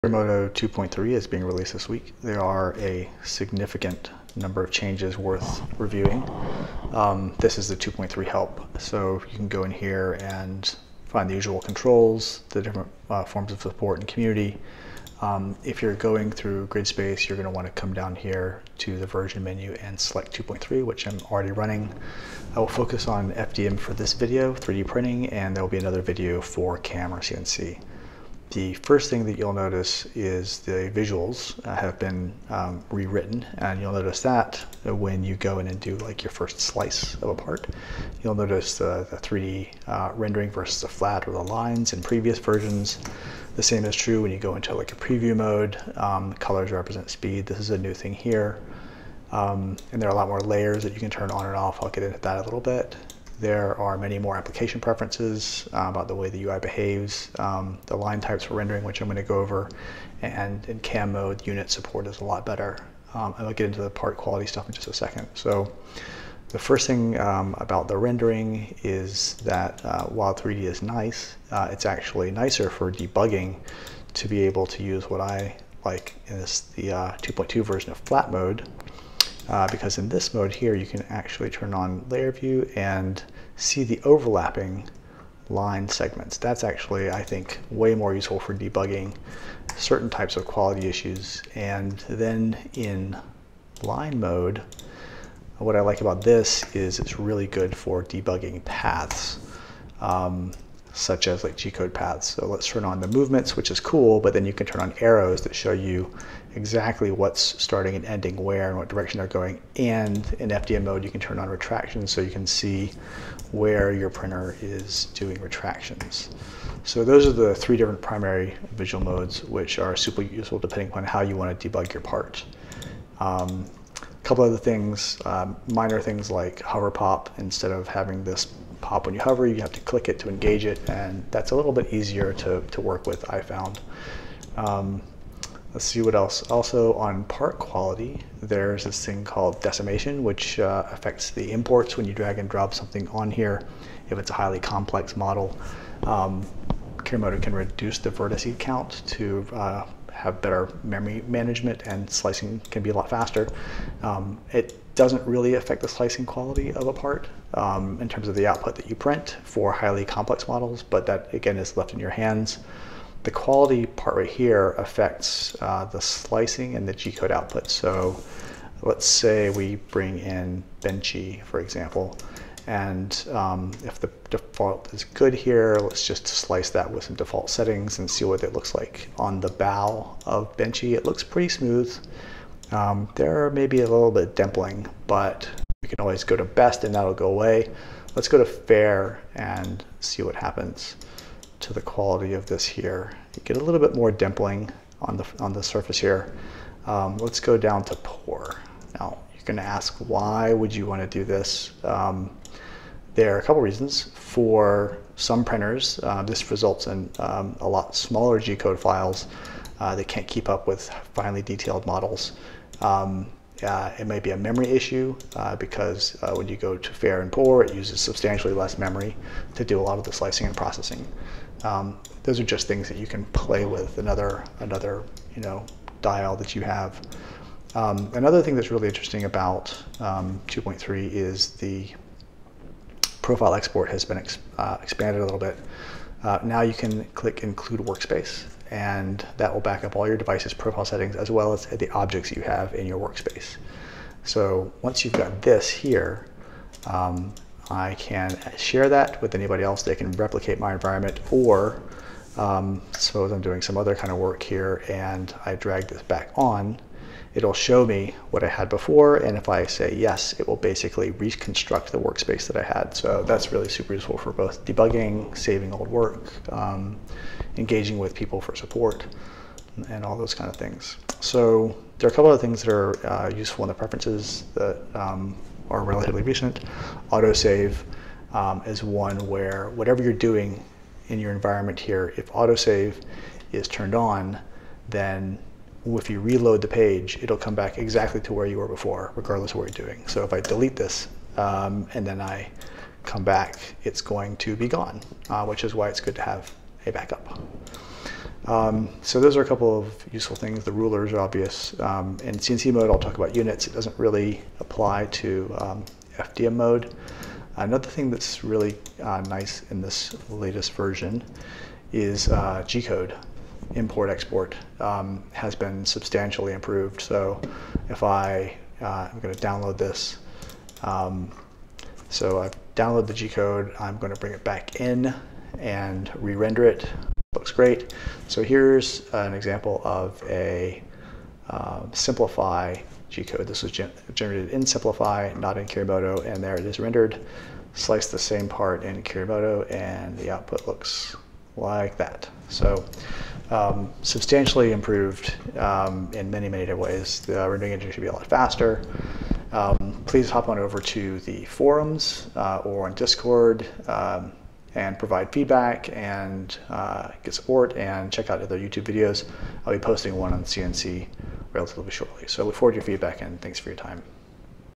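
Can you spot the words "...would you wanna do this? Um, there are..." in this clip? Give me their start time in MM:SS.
03:20.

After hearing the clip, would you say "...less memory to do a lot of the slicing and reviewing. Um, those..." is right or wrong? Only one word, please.
wrong.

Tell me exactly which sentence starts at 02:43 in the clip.
The quality part right here affects uh, the slicing and the G-code output.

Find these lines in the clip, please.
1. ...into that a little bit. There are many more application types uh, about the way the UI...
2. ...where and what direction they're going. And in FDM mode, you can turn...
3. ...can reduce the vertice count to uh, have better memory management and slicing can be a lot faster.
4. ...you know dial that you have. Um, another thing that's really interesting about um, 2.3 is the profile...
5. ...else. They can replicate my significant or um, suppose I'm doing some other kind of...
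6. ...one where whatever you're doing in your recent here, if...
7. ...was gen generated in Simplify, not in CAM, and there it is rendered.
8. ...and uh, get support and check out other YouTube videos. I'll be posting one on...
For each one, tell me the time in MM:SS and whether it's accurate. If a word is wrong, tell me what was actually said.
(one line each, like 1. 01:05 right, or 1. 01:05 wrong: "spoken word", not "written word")
1. 00:52 wrong: "preferences", not "types"
2. 01:48 right
3. 02:27 right
4. 03:45 right
5. 04:09 wrong: "environment", not "significant"
6. 04:38 wrong: "environment", not "recent"
7. 05:33 wrong: "Kirimoto", not "CAM"
8. 05:55 right.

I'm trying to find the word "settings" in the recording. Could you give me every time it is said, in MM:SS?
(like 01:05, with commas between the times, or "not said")
02:57, 04:00.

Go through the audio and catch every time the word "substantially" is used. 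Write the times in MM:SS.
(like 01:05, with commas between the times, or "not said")
03:38, 05:15, 05:44.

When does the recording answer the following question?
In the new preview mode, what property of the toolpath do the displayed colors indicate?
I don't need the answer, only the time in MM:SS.
00:46.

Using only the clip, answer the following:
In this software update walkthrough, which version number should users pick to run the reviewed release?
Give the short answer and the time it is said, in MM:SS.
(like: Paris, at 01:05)
2.3, at 00:19.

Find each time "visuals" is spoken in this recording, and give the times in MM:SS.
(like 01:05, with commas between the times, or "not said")
00:30, 01:58.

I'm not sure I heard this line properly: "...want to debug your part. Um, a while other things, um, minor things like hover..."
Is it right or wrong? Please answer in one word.
wrong.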